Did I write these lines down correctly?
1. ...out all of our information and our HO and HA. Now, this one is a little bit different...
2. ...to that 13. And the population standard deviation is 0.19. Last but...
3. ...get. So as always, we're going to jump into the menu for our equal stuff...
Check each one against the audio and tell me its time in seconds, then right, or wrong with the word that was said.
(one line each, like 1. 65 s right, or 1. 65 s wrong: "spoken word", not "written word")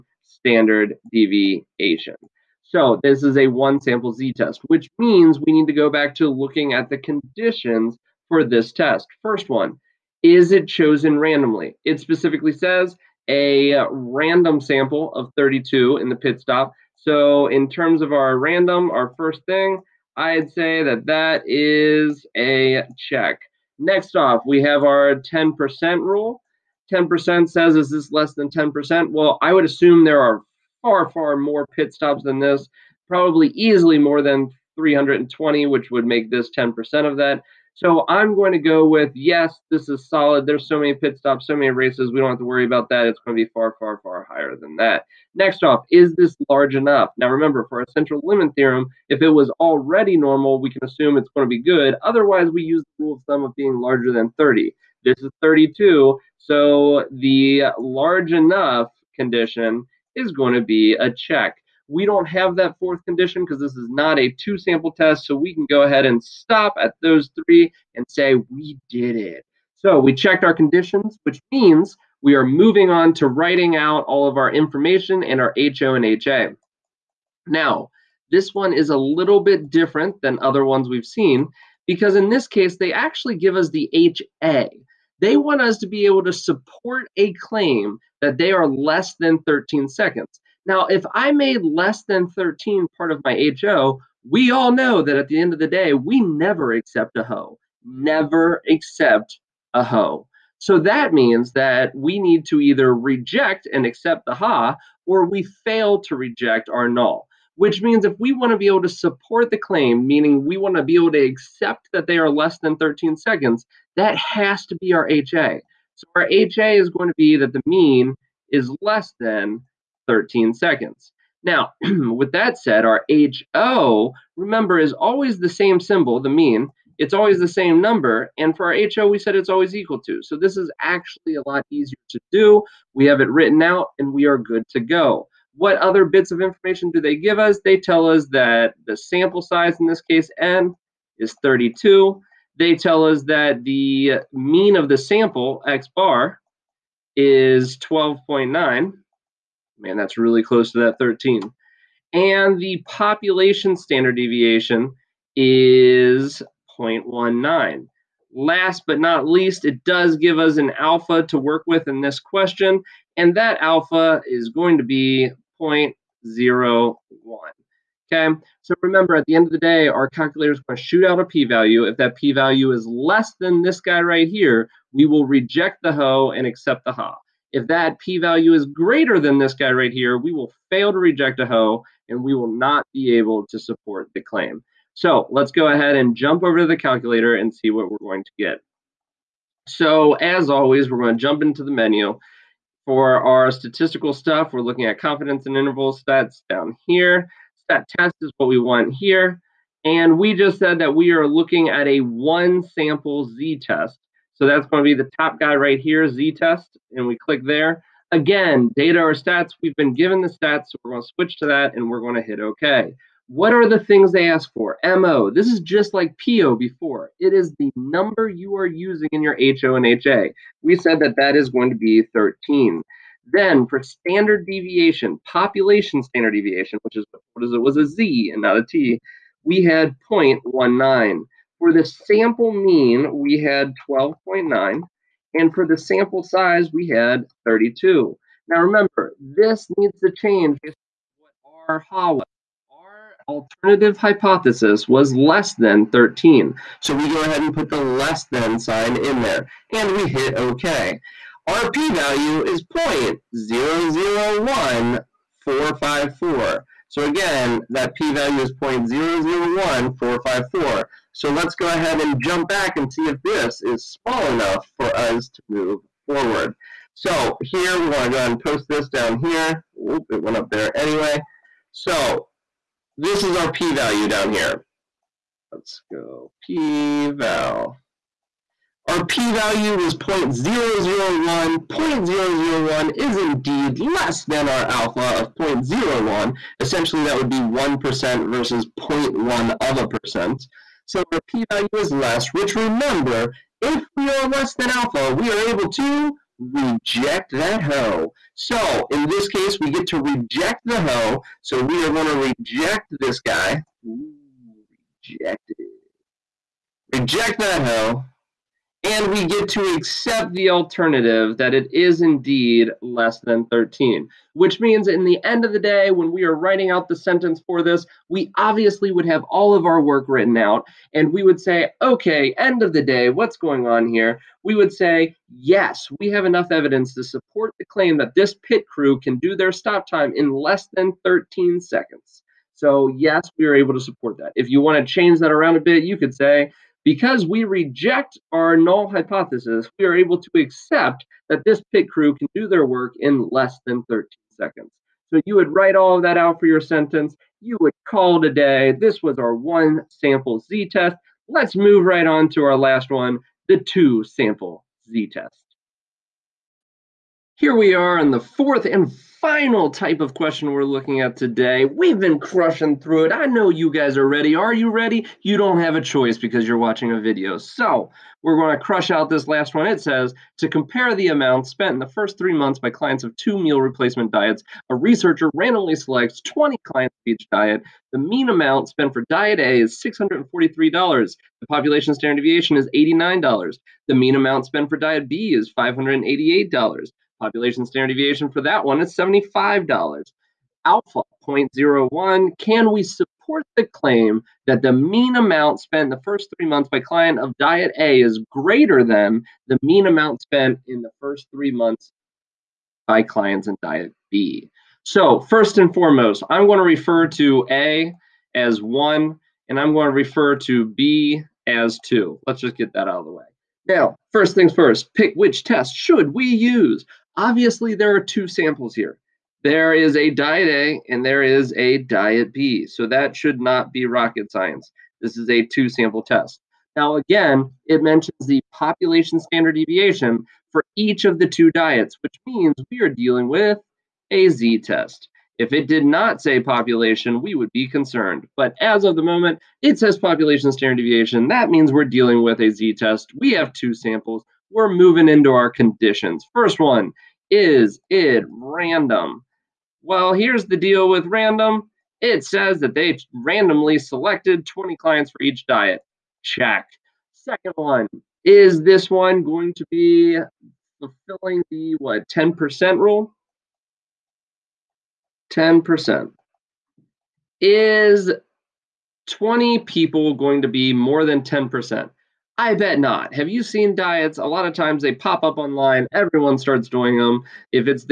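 1. 73 s right
2. 150 s right
3. 188 s wrong: "statistical", not "equal".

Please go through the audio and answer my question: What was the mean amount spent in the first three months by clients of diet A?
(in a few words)
$643.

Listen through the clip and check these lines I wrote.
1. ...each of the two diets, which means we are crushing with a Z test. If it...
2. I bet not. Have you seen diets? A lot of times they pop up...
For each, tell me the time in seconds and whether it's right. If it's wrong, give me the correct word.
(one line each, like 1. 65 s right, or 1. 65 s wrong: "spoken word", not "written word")
1. 430 s wrong: "dealing", not "crushing"
2. 472 s right.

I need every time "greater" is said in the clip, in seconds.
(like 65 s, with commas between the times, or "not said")
178 s, 398 s.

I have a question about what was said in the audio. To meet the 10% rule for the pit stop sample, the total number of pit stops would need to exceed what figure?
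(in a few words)
320.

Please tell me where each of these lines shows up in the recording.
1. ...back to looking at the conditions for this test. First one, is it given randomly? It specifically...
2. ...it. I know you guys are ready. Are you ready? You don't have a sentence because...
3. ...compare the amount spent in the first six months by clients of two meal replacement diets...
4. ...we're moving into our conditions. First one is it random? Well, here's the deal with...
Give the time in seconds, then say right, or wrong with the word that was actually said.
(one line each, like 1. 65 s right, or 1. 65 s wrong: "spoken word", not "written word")
1. 5 s wrong: "chosen", not "given"
2. 363 s wrong: "choice", not "sentence"
3. 370 s wrong: "three", not "six"
4. 444 s right.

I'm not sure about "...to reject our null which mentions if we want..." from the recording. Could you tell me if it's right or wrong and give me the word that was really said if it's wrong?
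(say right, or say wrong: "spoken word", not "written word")
wrong: "means", not "mentions".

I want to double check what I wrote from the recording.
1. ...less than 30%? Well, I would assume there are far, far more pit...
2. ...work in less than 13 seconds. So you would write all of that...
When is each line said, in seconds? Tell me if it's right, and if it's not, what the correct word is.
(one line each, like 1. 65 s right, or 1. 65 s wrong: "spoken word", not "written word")
1. 28 s wrong: "10", not "30"
2. 342 s right.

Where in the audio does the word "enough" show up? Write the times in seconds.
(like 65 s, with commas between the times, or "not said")
46 s, 58 s, 264 s, 326 s.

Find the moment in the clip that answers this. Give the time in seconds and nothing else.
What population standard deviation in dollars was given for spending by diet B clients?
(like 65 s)
388 s.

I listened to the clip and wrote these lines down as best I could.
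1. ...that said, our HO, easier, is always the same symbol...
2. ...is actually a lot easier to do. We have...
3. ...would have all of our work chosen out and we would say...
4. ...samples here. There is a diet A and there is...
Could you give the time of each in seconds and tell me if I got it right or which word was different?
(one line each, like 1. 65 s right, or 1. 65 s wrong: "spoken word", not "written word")
1. 122 s wrong: "remember", not "easier"
2. 130 s right
3. 318 s wrong: "written", not "chosen"
4. 418 s right.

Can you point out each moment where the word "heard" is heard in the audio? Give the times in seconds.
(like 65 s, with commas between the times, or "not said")
not said.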